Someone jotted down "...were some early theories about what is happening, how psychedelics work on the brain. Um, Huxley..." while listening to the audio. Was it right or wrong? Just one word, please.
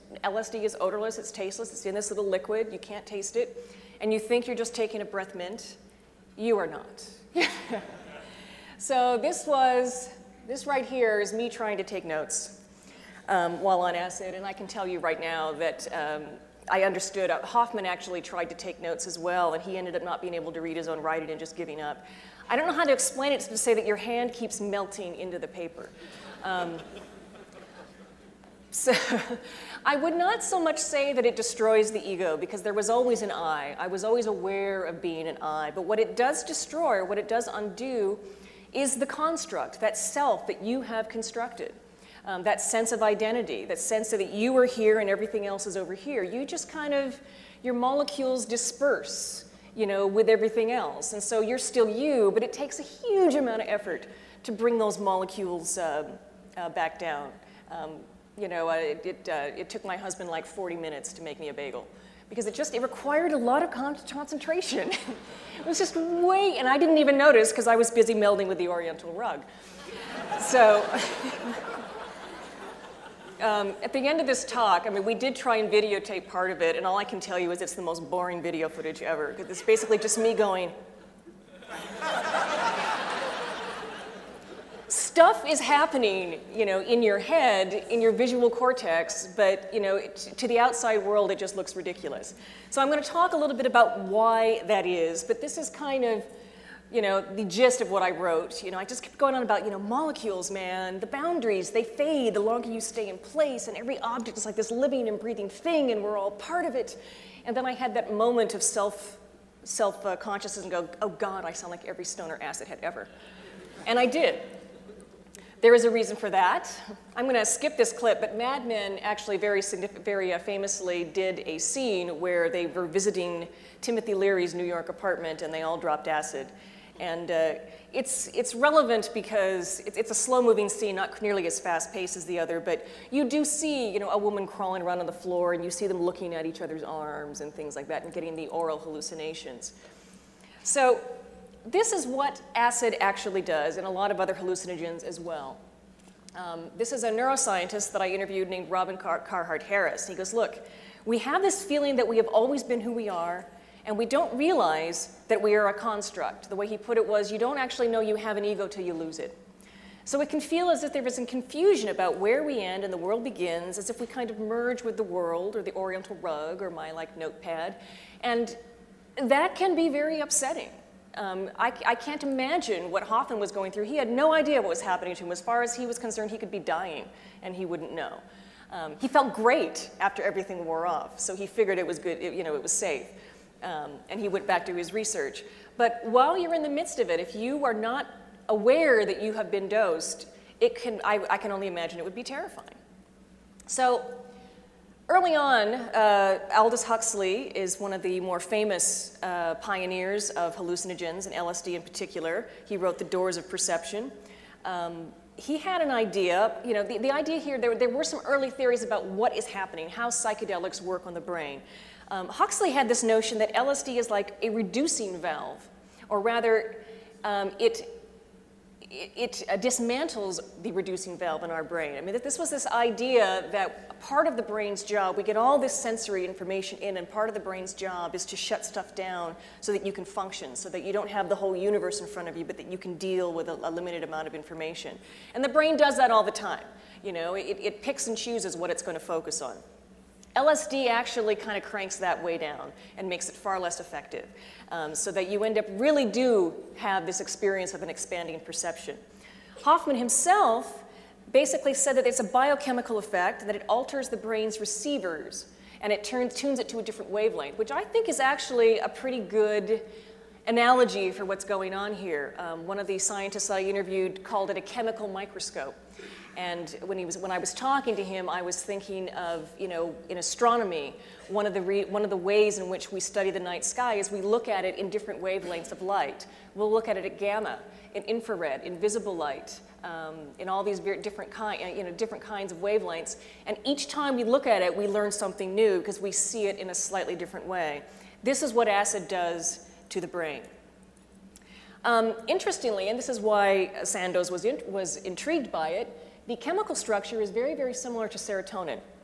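right.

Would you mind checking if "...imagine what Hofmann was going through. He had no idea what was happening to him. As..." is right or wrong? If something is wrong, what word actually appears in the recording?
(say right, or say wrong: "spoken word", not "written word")
right.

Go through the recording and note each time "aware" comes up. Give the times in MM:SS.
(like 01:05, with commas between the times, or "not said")
00:34, 03:08.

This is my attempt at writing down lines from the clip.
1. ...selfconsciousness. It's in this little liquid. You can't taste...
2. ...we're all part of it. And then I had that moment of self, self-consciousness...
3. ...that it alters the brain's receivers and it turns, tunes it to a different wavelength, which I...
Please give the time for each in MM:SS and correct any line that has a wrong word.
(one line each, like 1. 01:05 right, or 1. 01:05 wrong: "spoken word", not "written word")
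1. 00:01 wrong: "tasteless", not "selfconsciousness"
2. 01:46 right
3. 04:13 right.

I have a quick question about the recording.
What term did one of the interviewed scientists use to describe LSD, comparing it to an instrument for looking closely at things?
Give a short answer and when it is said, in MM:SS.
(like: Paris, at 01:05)
chemical microscope, at 04:24.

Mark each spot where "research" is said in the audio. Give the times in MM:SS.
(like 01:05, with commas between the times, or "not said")
03:04.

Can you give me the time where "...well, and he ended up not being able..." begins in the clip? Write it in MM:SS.
00:19.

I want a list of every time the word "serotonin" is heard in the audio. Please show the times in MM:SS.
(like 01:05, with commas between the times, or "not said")
04:58.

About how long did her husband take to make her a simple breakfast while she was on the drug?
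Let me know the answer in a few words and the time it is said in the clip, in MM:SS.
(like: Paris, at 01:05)
40 minutes, at 01:00.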